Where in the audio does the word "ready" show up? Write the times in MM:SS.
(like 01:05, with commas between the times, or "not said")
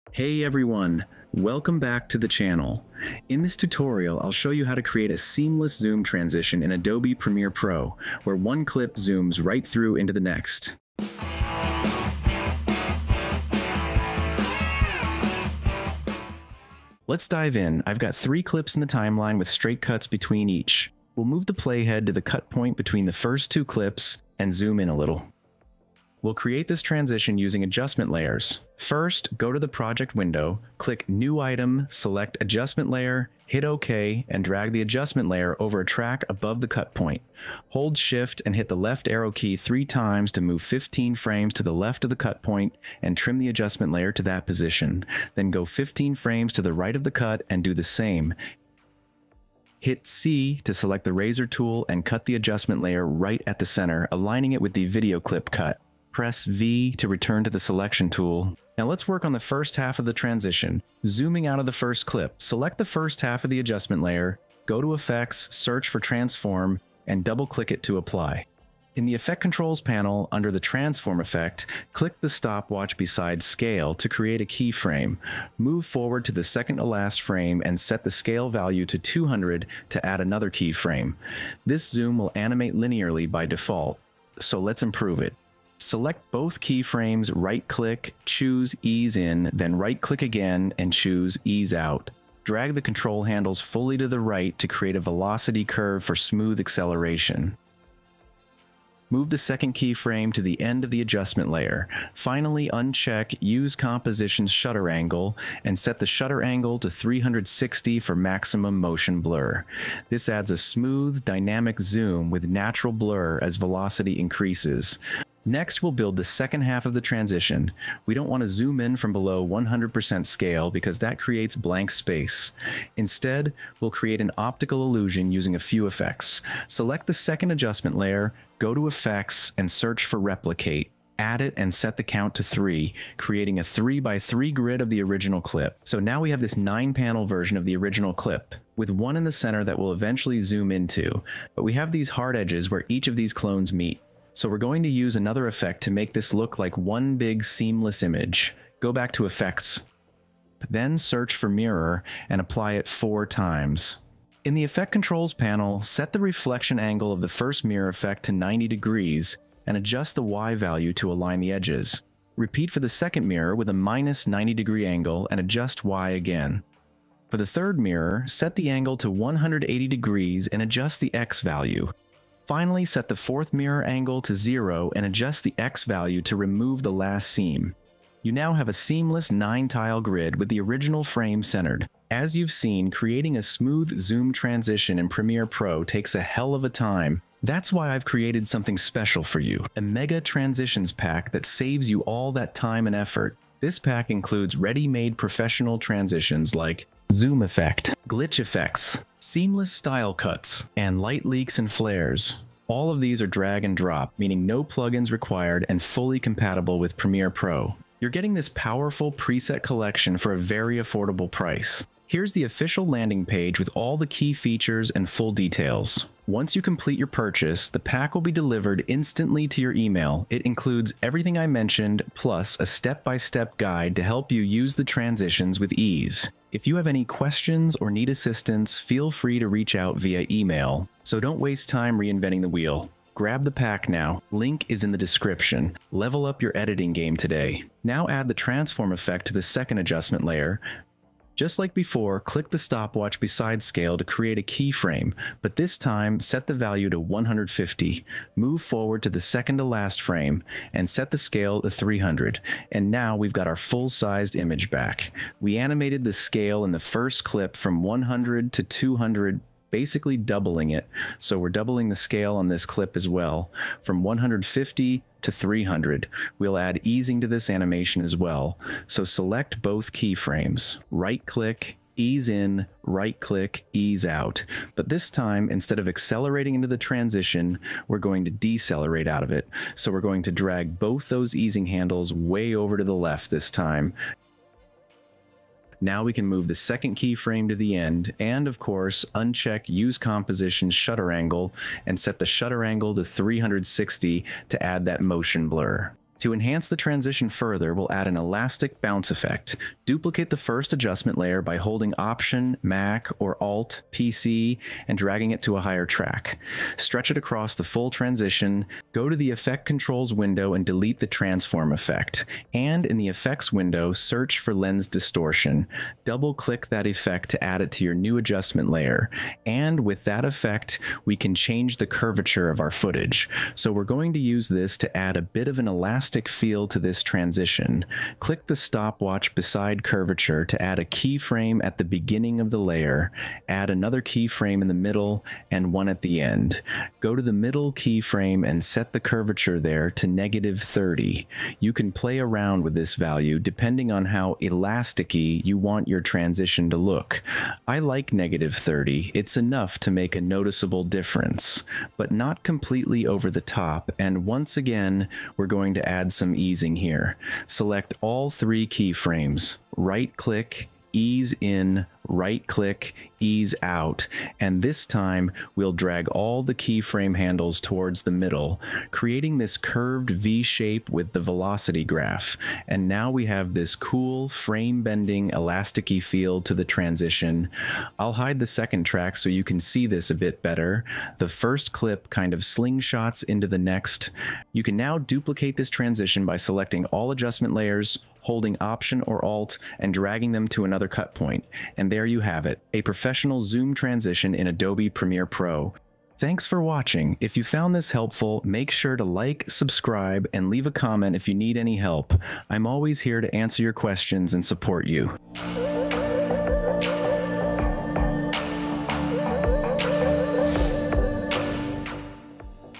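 03:14.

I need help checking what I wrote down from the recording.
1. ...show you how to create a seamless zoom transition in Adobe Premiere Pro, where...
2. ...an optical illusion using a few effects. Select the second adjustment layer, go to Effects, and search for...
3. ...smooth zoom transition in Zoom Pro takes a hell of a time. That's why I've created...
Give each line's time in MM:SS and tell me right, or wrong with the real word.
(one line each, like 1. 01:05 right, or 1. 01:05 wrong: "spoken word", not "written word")
1. 00:04 right
2. 02:04 right
3. 03:03 wrong: "Premiere", not "Zoom".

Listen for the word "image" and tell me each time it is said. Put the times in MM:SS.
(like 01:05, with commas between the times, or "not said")
02:28, 04:14.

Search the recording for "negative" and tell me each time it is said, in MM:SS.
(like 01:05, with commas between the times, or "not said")
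05:40, 05:48.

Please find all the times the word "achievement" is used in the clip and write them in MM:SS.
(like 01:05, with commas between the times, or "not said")
not said.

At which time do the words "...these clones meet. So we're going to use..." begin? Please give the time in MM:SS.
02:23.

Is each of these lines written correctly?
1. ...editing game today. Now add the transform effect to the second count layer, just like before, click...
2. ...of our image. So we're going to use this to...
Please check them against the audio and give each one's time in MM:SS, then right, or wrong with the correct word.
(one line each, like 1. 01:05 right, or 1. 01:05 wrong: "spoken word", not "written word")
1. 03:56 wrong: "adjustment", not "count"
2. 05:22 wrong: "footage", not "image".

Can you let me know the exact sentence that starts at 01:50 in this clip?
This adds a smooth, dynamic zoom with natural blur as velocity increases.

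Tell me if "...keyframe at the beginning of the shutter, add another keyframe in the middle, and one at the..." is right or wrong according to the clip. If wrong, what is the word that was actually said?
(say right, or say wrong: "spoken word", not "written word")
wrong: "layer", not "shutter".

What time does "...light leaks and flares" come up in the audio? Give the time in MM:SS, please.
03:21.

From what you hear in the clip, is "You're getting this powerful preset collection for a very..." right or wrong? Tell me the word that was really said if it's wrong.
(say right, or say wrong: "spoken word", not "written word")
right.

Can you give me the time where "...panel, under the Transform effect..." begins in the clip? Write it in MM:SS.
01:09.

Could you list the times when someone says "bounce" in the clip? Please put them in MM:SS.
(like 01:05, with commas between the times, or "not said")
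04:58.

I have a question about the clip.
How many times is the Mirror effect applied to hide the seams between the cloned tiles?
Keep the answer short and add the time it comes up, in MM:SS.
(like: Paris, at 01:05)
4, at 02:32.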